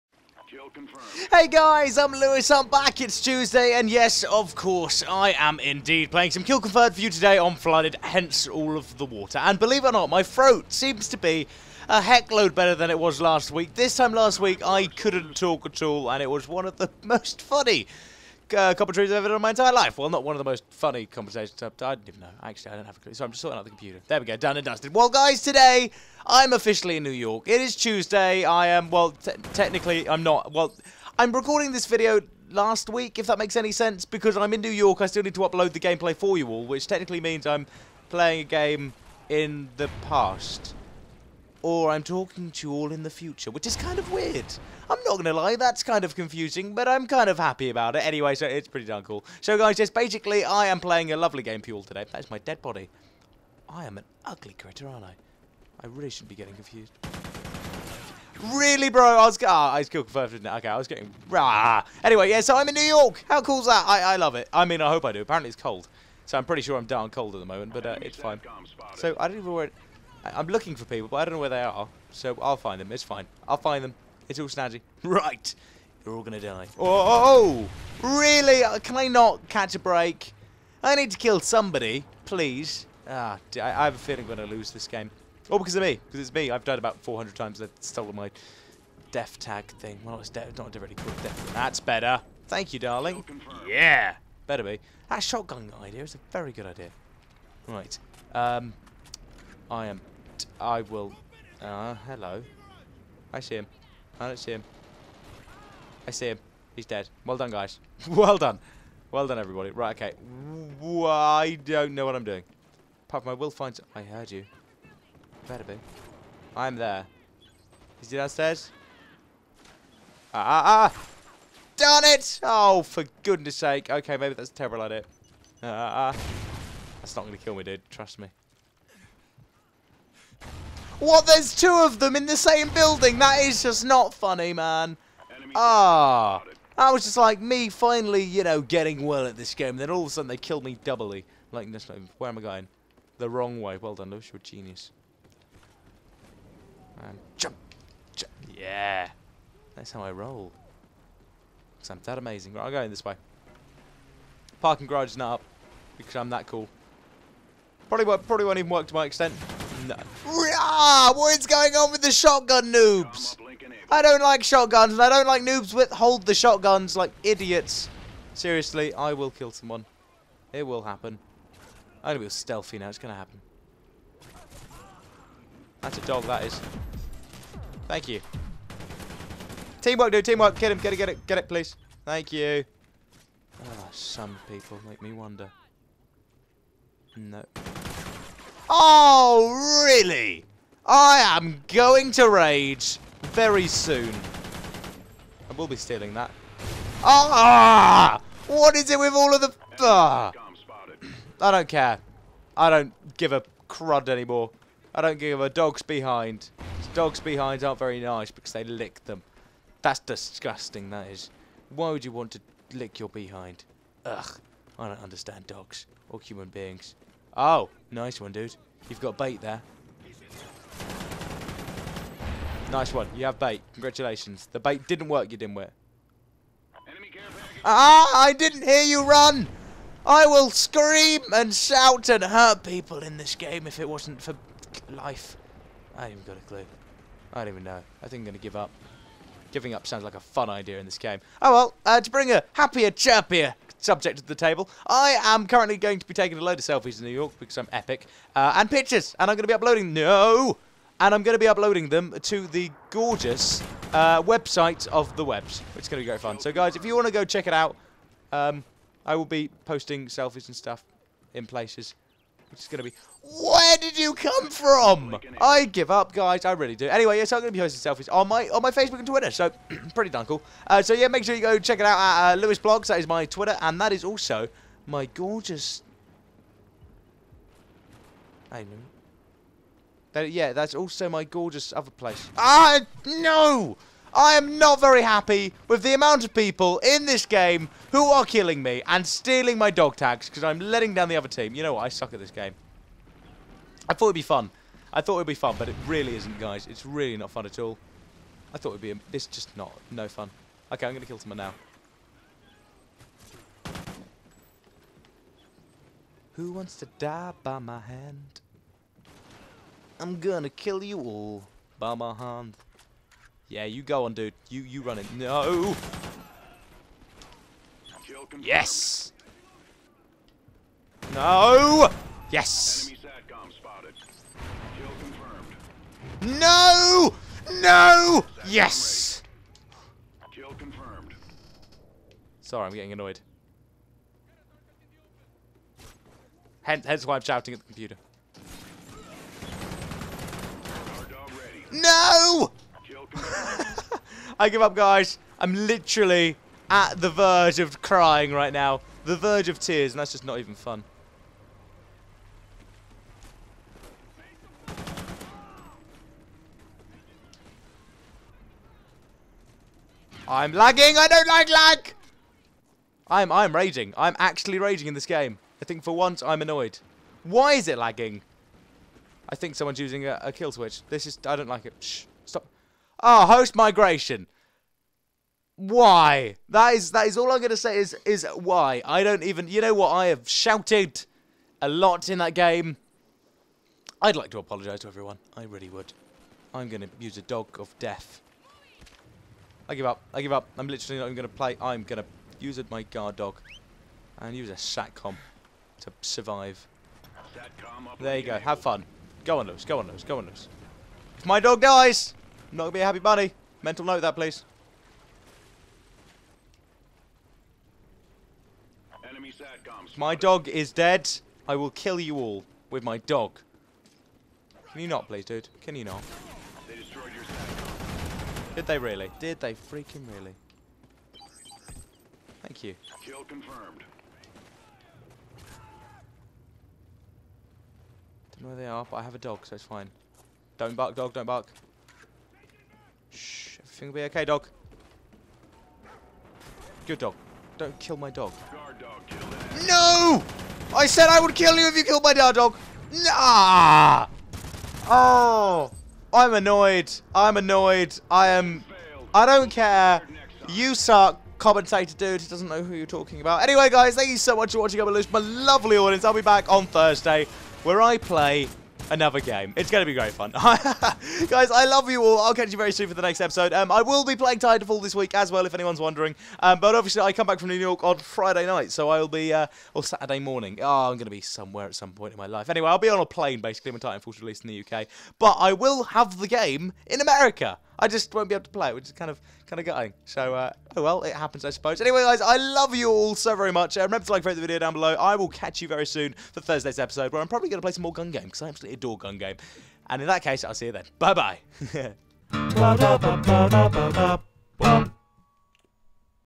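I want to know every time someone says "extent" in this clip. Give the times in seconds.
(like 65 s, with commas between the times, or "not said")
159 s.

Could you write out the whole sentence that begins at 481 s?
Anyway, guys, I love you all so very much.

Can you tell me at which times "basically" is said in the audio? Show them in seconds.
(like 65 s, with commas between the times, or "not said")
49 s, 473 s.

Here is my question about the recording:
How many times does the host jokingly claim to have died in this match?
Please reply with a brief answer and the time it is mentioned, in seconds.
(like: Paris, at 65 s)
400, at 87 s.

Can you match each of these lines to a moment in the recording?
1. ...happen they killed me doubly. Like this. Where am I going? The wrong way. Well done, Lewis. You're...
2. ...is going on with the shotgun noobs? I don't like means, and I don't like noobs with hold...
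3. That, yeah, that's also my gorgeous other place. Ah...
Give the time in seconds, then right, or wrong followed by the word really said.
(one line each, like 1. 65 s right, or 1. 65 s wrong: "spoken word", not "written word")
1. 140 s wrong: "sudden", not "happen"
2. 161 s wrong: "shotguns", not "means"
3. 280 s right.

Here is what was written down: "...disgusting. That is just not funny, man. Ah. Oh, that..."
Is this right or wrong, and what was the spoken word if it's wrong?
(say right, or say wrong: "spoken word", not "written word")
wrong: "building", not "disgusting".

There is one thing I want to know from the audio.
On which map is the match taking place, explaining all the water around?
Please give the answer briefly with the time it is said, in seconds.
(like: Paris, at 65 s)
Flooded, at 7 s.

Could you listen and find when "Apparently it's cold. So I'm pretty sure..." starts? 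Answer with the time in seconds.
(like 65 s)
65 s.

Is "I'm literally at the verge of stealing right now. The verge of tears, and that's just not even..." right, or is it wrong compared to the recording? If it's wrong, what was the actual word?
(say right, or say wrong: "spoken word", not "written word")
wrong: "crying", not "stealing".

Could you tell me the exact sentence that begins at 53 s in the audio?
I am an ugly critter, aren't I?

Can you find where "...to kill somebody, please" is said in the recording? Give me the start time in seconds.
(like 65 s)
81 s.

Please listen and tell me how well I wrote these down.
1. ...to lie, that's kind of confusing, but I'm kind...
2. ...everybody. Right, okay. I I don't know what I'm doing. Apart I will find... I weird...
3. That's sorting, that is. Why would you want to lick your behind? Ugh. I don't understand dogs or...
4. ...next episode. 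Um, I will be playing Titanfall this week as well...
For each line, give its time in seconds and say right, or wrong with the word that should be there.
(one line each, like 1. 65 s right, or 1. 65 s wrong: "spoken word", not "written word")
1. 45 s right
2. 109 s wrong: "heard", not "weird"
3. 209 s wrong: "disgusting", not "sorting"
4. 463 s right.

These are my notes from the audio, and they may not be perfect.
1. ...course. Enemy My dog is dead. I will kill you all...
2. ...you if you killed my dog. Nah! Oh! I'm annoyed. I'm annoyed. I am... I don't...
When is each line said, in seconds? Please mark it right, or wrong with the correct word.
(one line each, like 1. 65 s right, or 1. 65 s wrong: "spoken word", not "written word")
1. 404 s wrong: "please", not "course"
2. 441 s right.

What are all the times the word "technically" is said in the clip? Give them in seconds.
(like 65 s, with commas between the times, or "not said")
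29 s, 36 s.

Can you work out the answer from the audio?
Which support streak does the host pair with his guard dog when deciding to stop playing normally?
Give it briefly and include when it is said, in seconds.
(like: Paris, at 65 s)
SATCOM, at 394 s.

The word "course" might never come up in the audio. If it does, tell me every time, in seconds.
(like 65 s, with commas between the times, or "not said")
4 s.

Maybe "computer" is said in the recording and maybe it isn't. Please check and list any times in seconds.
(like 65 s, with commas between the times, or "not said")
23 s, 337 s.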